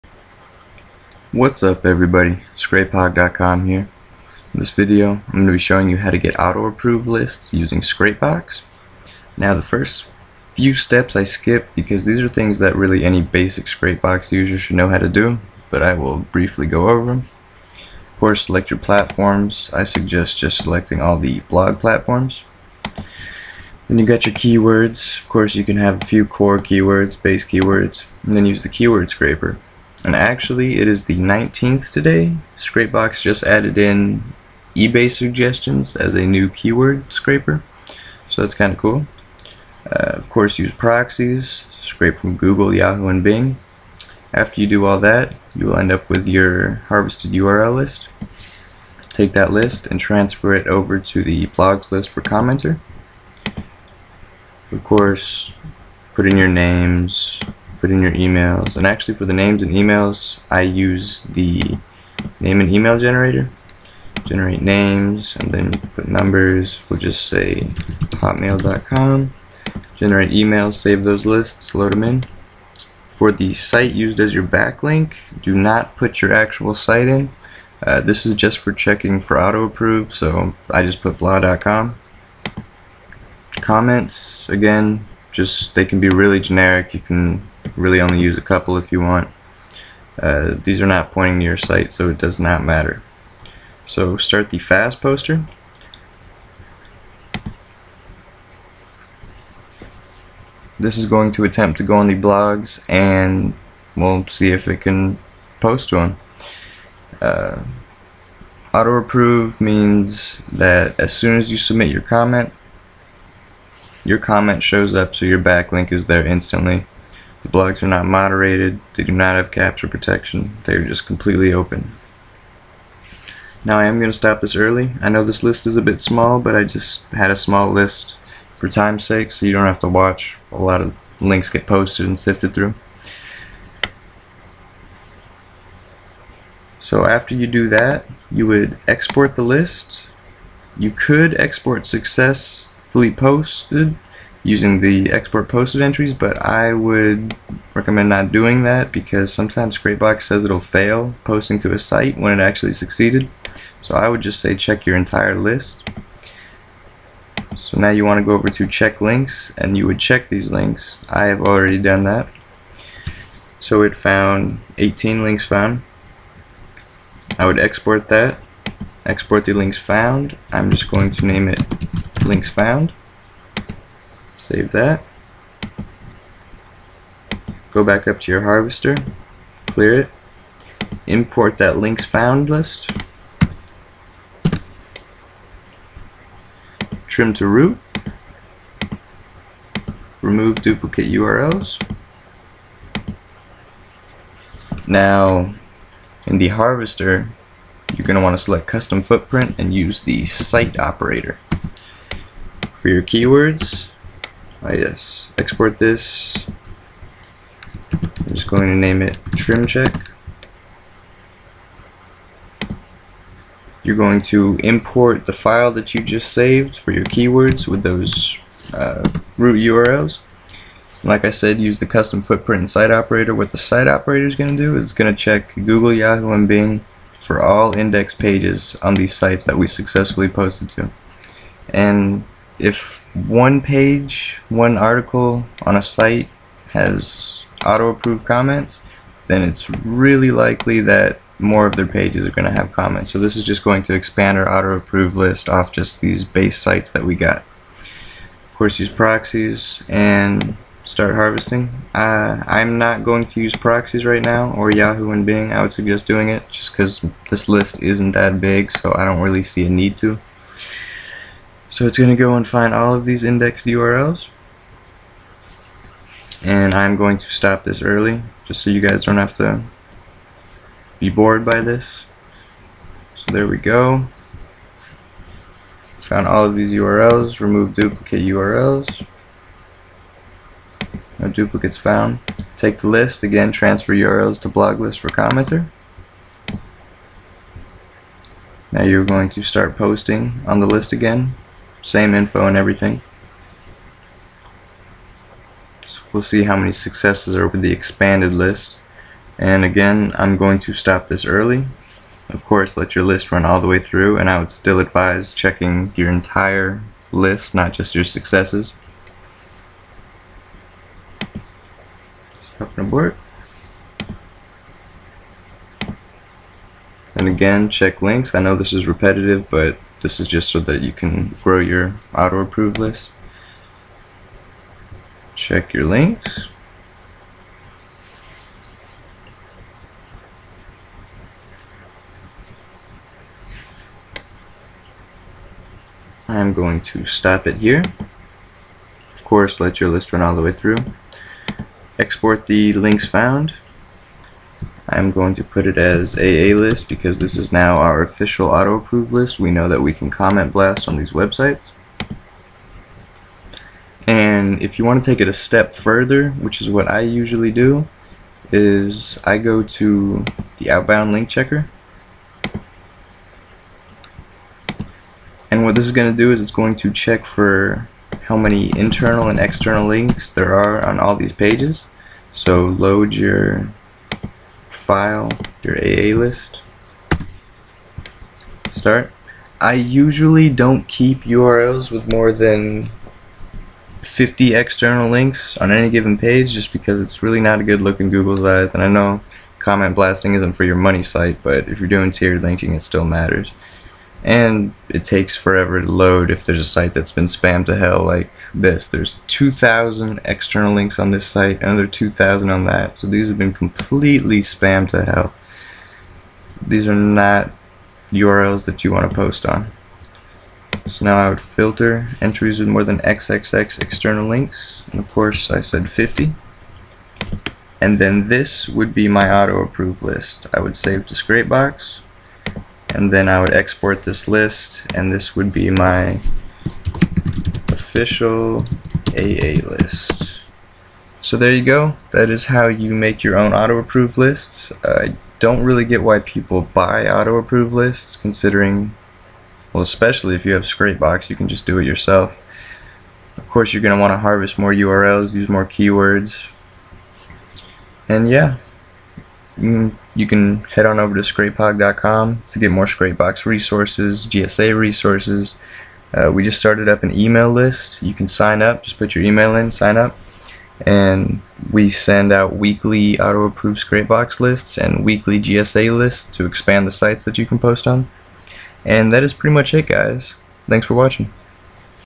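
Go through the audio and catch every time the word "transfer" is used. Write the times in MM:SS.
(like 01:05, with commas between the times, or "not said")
00:49, 04:43.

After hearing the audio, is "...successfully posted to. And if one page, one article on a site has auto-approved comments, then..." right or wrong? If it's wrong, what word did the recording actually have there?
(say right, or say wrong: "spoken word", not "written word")
right.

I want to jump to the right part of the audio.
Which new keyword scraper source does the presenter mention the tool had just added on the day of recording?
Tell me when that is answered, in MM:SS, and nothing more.
00:34.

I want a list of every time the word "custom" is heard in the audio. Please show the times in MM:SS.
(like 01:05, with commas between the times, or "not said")
03:18, 03:41.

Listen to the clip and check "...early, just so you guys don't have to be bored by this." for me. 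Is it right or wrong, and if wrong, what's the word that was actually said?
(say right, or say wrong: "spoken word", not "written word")
right.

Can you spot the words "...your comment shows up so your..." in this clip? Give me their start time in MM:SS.
01:54.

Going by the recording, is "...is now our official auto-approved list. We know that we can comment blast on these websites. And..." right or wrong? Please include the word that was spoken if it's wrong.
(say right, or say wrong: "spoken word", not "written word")
right.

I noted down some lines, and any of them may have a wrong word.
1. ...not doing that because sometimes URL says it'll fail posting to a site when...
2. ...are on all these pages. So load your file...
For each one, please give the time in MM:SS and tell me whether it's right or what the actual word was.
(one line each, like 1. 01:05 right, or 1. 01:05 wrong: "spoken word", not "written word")
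1. 02:28 wrong: "Scrapebox", not "URL"
2. 06:10 right.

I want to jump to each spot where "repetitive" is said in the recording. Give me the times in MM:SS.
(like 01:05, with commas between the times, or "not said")
05:18.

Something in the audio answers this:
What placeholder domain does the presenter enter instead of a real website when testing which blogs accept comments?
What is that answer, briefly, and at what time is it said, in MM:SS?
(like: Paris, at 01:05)
blah.com, at 01:21.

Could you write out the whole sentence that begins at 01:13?
For the site used as your backlink, do not put your actual site in.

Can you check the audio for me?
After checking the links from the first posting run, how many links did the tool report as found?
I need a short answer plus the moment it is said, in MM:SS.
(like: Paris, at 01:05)
18, at 02:44.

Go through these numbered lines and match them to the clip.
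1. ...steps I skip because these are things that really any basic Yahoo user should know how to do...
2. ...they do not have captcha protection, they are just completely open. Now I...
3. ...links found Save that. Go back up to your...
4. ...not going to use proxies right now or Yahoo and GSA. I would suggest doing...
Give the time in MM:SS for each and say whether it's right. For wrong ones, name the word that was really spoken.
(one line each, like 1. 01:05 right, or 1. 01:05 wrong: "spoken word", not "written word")
1. 00:10 wrong: "Scrapebox", not "Yahoo"
2. 01:58 right
3. 02:52 right
4. 04:12 wrong: "Bing", not "GSA".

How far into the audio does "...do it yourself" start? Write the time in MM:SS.
07:21.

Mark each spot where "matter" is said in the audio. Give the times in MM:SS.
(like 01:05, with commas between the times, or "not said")
01:32, 06:33.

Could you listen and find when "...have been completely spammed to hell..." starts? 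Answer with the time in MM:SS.
06:43.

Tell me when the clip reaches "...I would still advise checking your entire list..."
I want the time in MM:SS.
05:04.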